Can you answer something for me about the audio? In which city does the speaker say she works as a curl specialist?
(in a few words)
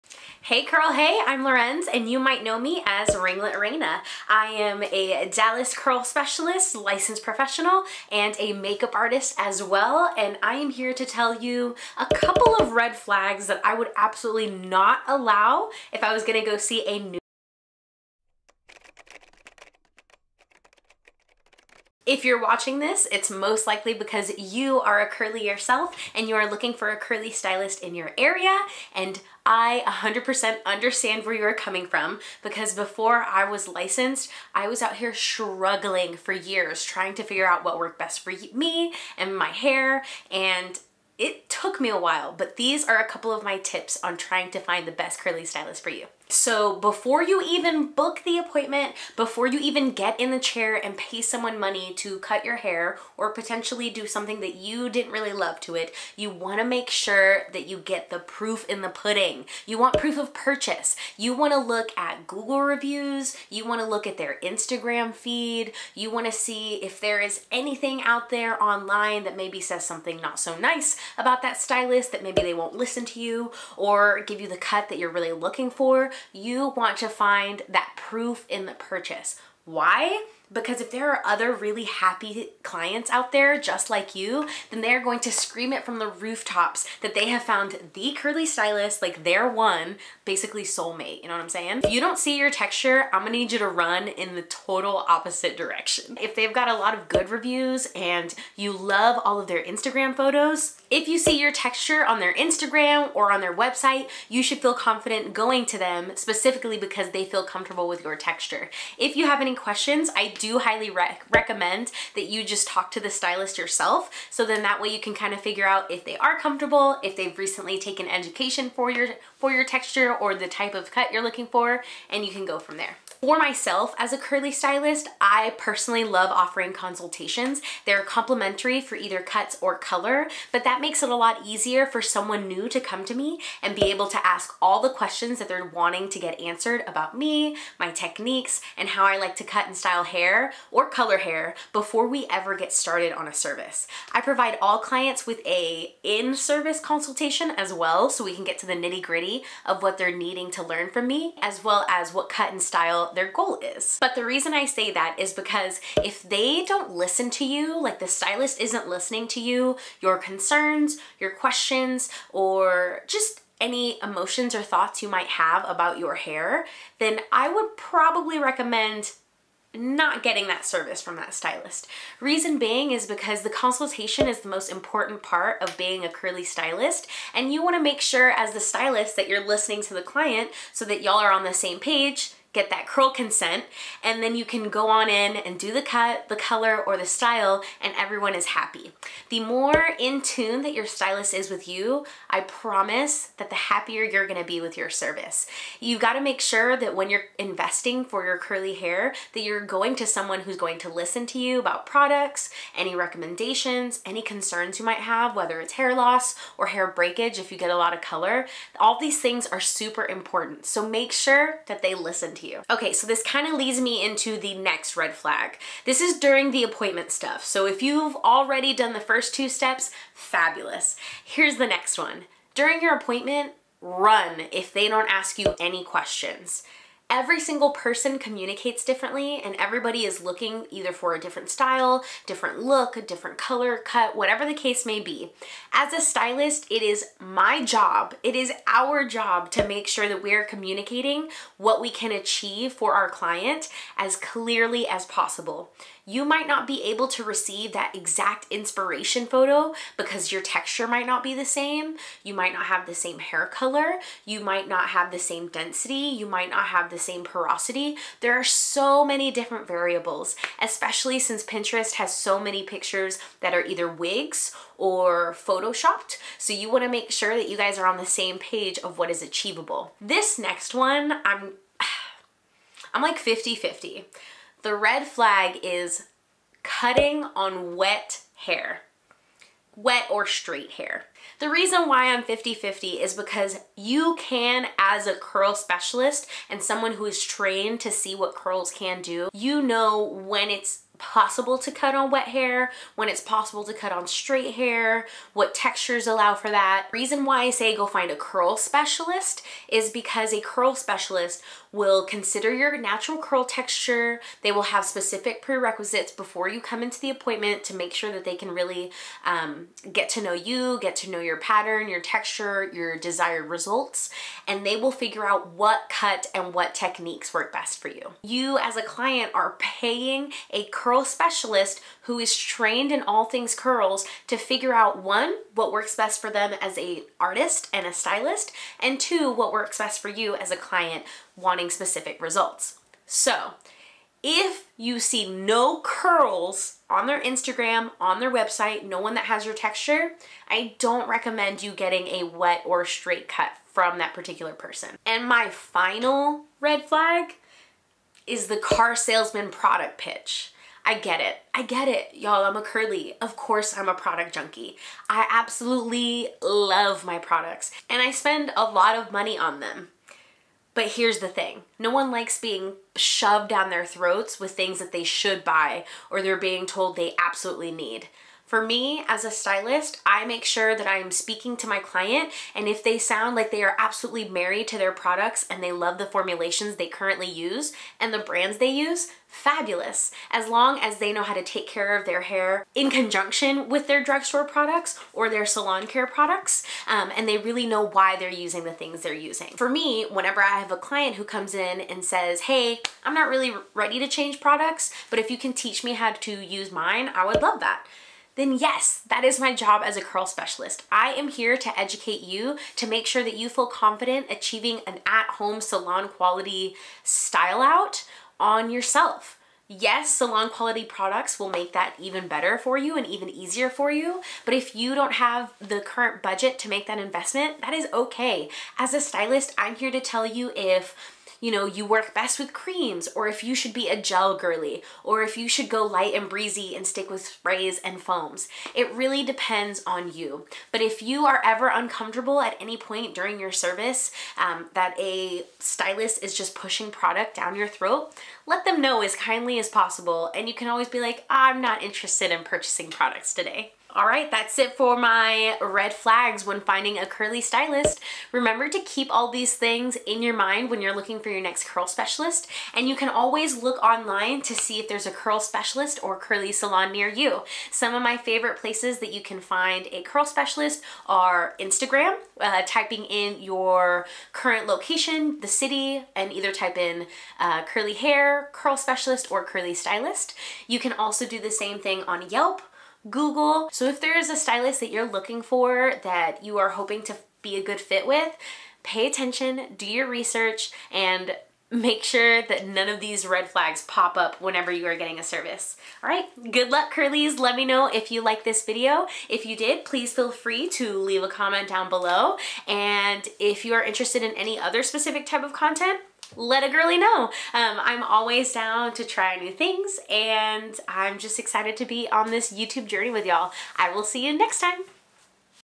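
Dallas.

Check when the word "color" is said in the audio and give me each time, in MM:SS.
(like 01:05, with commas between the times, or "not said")
02:09, 02:20, 03:06, 03:28, 03:53, 04:13.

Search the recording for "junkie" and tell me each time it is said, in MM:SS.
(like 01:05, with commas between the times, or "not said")
05:54.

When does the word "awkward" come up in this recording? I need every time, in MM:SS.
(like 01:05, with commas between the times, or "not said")
not said.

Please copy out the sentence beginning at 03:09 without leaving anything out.
The more in tune that your stylist is with you, I promise that the happier you're gonna be with your service.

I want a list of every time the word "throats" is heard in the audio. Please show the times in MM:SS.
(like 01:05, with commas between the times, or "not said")
06:03, 07:17.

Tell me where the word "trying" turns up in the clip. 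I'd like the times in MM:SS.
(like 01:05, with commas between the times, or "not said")
00:36, 00:44.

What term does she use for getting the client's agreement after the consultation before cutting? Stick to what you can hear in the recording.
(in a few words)
curl consent.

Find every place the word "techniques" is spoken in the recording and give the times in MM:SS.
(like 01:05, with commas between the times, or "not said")
02:17, 05:16.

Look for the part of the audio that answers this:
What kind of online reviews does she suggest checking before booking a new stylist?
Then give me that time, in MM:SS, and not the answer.
01:02.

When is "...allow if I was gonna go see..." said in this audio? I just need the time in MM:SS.
00:15.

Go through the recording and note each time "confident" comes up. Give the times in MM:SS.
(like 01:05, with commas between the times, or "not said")
01:44, 06:43.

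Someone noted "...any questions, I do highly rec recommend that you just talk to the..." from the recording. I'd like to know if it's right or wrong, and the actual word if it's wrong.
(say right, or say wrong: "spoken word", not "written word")
right.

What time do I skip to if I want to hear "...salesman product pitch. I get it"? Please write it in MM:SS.
05:48.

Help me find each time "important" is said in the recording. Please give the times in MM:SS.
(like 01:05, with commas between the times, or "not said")
02:54, 03:30.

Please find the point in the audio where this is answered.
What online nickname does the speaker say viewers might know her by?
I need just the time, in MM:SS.
00:03.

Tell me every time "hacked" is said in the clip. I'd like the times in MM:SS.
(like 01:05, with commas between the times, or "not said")
not said.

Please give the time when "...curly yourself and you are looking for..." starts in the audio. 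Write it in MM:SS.
00:25.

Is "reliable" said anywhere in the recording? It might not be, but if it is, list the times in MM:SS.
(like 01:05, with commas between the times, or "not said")
not said.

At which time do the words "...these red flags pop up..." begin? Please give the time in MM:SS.
08:02.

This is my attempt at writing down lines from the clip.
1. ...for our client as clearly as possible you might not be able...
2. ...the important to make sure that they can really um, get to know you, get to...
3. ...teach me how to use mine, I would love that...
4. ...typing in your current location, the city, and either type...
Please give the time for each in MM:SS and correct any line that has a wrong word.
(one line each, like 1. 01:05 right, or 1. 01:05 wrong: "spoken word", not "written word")
1. 04:02 right
2. 05:06 wrong: "appointment", not "important"
3. 06:35 right
4. 07:42 right.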